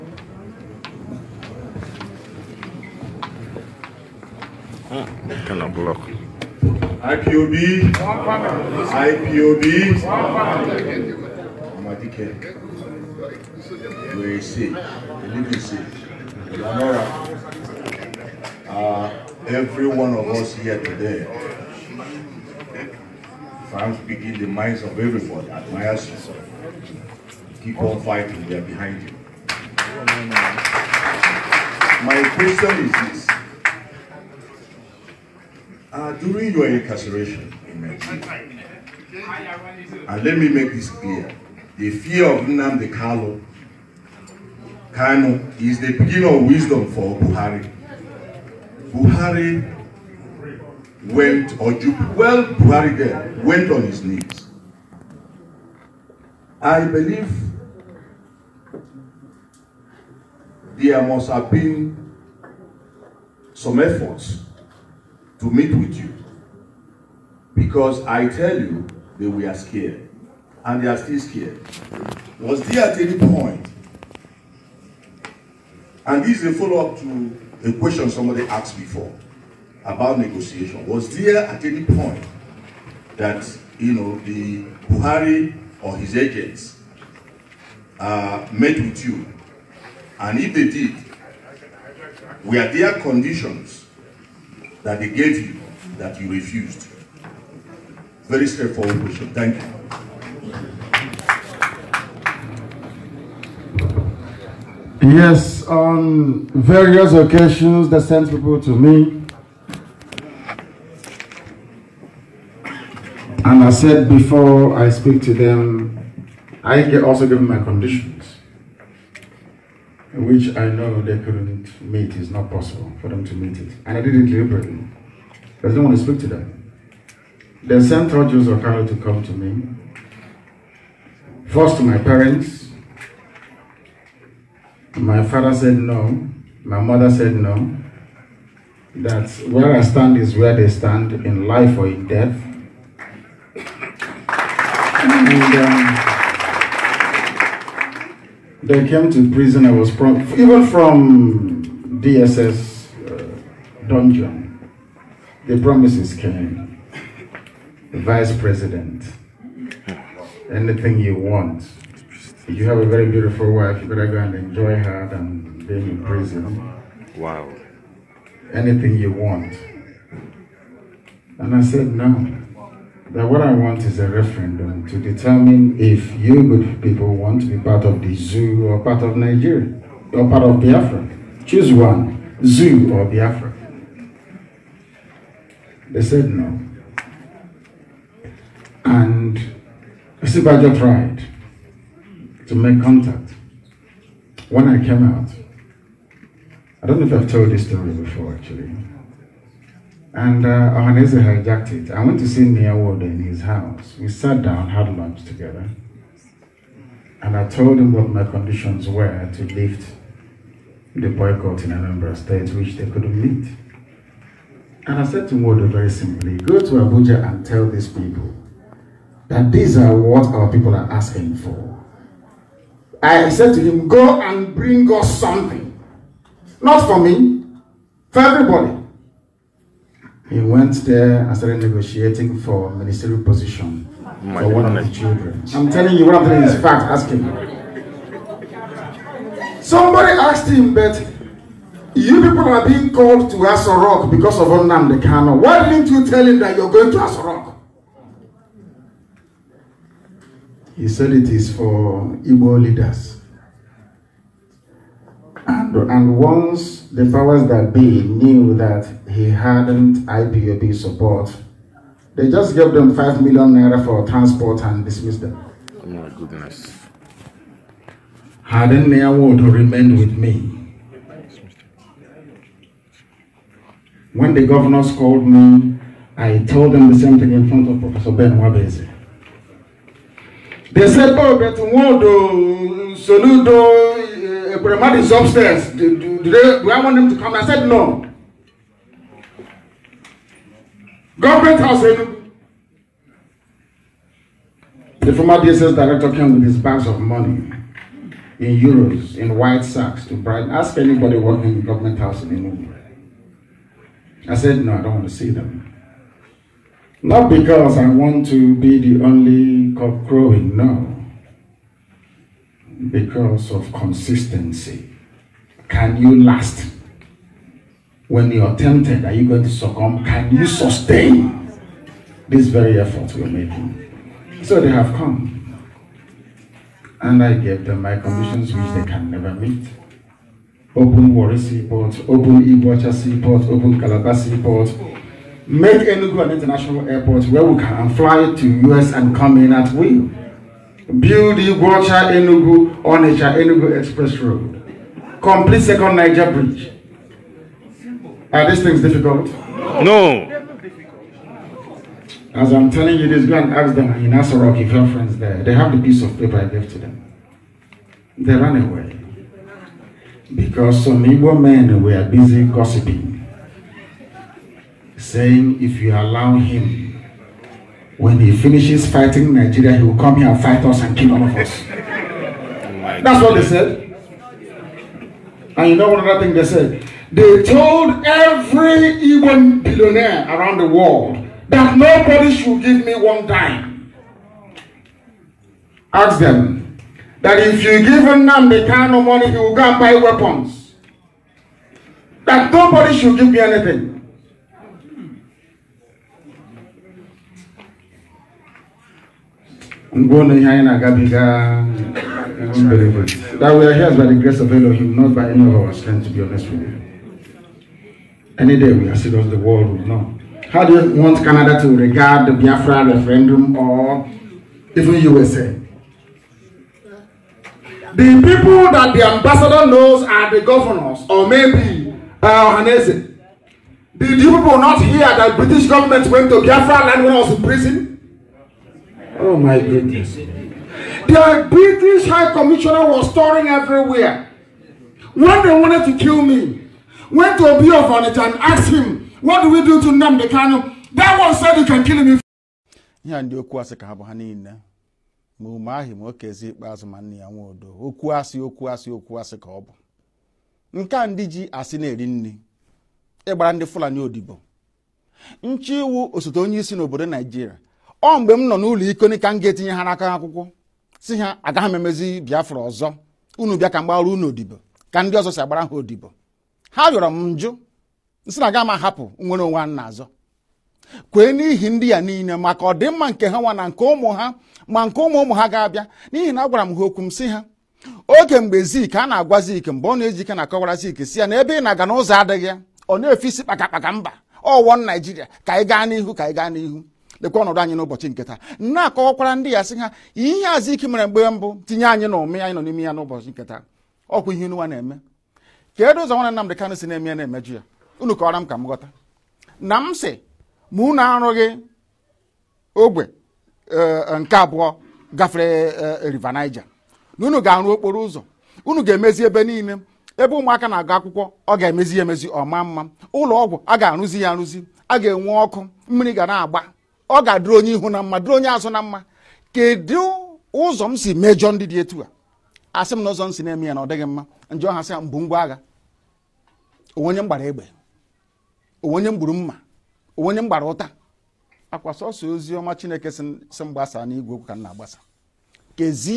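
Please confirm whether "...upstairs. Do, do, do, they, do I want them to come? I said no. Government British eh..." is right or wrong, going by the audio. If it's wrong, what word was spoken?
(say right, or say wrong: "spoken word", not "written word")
wrong: "House", not "British".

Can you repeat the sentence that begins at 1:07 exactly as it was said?
Because I tell you, they were scared.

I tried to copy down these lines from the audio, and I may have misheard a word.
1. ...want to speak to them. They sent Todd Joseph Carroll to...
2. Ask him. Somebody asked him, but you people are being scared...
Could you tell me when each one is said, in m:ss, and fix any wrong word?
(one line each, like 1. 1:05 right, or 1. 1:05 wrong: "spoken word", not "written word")
1. 2:05 right
2. 3:56 wrong: "called", not "scared".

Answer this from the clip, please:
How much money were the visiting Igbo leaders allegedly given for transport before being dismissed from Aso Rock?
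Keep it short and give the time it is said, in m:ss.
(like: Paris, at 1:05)
5 million naira, at 4:22.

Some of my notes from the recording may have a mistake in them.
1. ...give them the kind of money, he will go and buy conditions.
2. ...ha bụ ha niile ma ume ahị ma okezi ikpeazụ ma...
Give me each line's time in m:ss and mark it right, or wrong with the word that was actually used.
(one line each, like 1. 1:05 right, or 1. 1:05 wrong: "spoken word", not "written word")
1. 6:27 wrong: "weapons", not "conditions"
2. 7:23 right.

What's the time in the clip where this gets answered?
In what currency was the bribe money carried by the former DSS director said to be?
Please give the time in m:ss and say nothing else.
4:58.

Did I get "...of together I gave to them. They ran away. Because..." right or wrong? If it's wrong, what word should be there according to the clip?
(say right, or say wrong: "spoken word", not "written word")
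wrong: "paper", not "together".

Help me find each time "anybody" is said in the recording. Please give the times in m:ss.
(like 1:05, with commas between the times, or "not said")
5:00.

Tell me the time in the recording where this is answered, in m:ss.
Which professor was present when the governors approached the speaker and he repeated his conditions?
4:37.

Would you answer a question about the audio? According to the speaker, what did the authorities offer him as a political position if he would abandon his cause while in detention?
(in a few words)
Vice president.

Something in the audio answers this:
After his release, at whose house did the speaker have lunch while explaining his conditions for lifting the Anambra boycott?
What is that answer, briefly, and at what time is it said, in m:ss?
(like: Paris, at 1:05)
Nnia Nwodo, at 3:22.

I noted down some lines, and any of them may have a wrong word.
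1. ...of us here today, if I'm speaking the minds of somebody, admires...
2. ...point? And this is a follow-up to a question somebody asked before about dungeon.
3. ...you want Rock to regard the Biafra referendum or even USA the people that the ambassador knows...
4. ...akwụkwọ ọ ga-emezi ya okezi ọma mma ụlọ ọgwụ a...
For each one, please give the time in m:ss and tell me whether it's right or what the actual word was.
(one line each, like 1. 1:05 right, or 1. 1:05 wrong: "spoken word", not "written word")
1. 0:20 wrong: "everybody", not "somebody"
2. 1:13 wrong: "negotiation", not "dungeon"
3. 6:50 wrong: "Canada", not "Rock"
4. 8:30 wrong: "emezi", not "okezi".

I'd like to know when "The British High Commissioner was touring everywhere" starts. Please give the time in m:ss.
7:11.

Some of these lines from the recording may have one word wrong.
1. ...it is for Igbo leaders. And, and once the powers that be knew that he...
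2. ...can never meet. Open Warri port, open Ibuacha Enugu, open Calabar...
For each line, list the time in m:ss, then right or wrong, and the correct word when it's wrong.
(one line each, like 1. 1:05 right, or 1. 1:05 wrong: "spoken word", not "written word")
1. 4:11 right
2. 5:28 wrong: "Seaport", not "Enugu".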